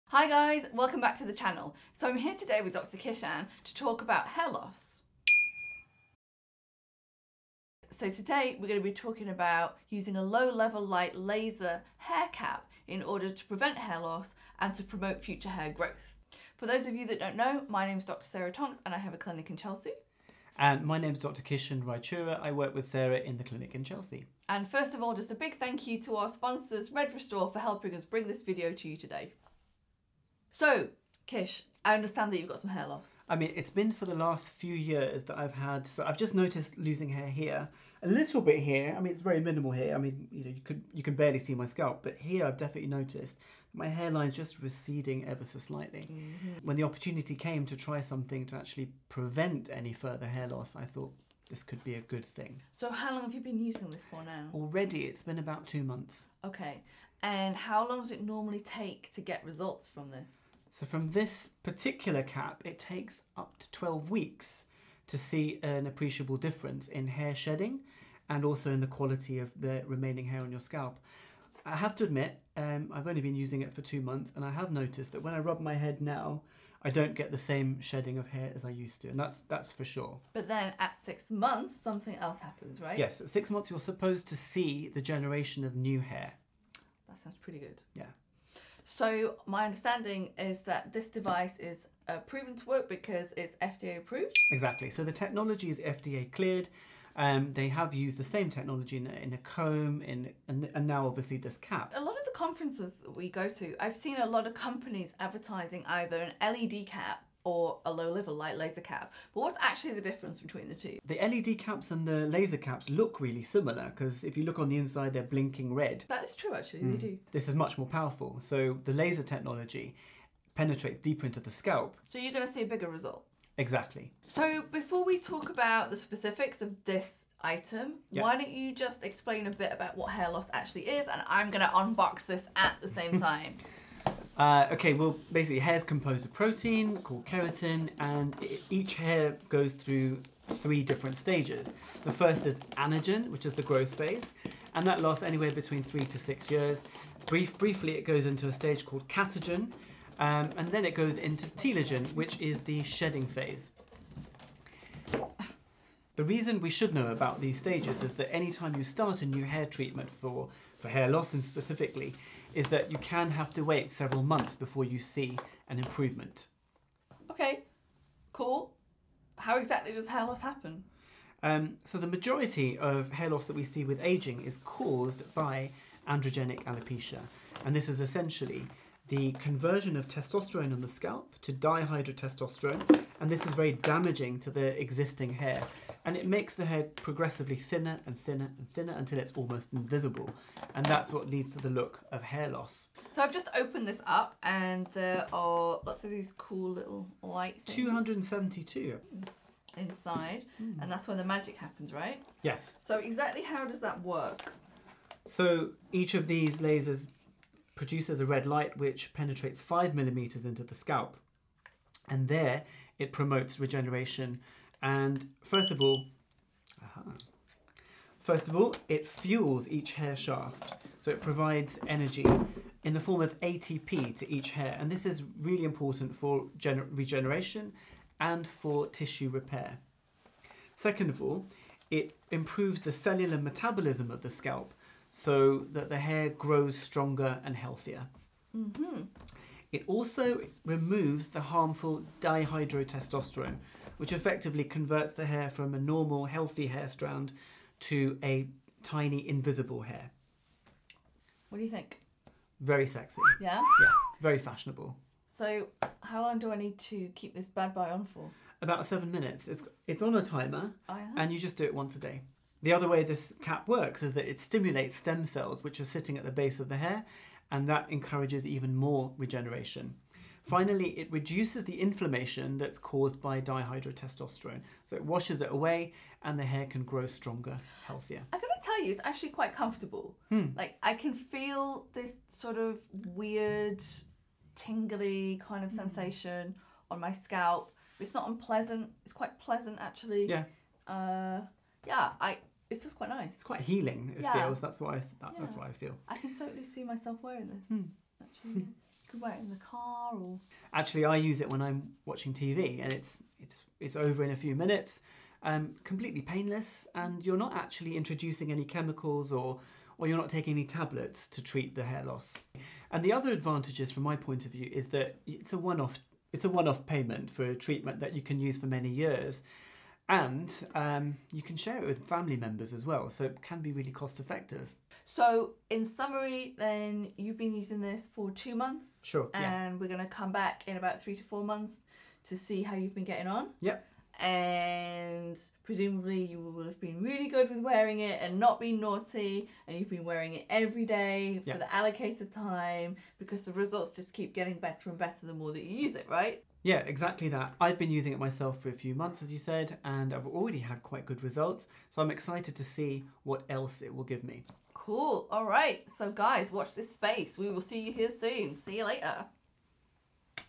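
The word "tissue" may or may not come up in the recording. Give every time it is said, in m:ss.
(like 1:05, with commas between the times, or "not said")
3:48.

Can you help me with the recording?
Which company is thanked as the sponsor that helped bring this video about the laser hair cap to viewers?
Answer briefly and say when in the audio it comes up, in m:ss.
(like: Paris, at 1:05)
Red Restore, at 0:26.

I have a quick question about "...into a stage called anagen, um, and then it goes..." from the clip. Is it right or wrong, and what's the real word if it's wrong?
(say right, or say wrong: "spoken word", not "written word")
wrong: "catagen", not "anagen".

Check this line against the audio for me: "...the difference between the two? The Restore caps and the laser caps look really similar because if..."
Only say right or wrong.
wrong.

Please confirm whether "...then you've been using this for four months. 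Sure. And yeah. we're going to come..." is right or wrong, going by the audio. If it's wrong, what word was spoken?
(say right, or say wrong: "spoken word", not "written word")
wrong: "two", not "four".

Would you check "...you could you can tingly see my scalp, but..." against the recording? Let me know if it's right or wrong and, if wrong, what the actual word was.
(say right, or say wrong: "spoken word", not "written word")
wrong: "barely", not "tingly".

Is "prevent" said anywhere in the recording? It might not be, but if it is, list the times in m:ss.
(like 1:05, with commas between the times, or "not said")
0:13, 0:49.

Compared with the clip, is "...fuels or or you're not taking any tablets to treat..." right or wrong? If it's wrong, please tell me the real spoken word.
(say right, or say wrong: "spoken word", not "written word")
wrong: "chemicals", not "fuels".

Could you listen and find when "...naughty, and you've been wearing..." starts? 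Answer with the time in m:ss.
5:38.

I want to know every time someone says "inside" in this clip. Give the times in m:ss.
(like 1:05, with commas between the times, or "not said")
1:54, 3:19.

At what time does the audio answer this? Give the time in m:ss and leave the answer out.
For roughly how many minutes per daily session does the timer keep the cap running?
4:18.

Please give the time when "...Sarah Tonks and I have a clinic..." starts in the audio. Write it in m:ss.
0:18.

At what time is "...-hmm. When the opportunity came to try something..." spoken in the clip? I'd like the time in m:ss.
0:46.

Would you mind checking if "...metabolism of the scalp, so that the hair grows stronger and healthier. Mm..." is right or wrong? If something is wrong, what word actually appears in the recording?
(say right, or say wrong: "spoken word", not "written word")
right.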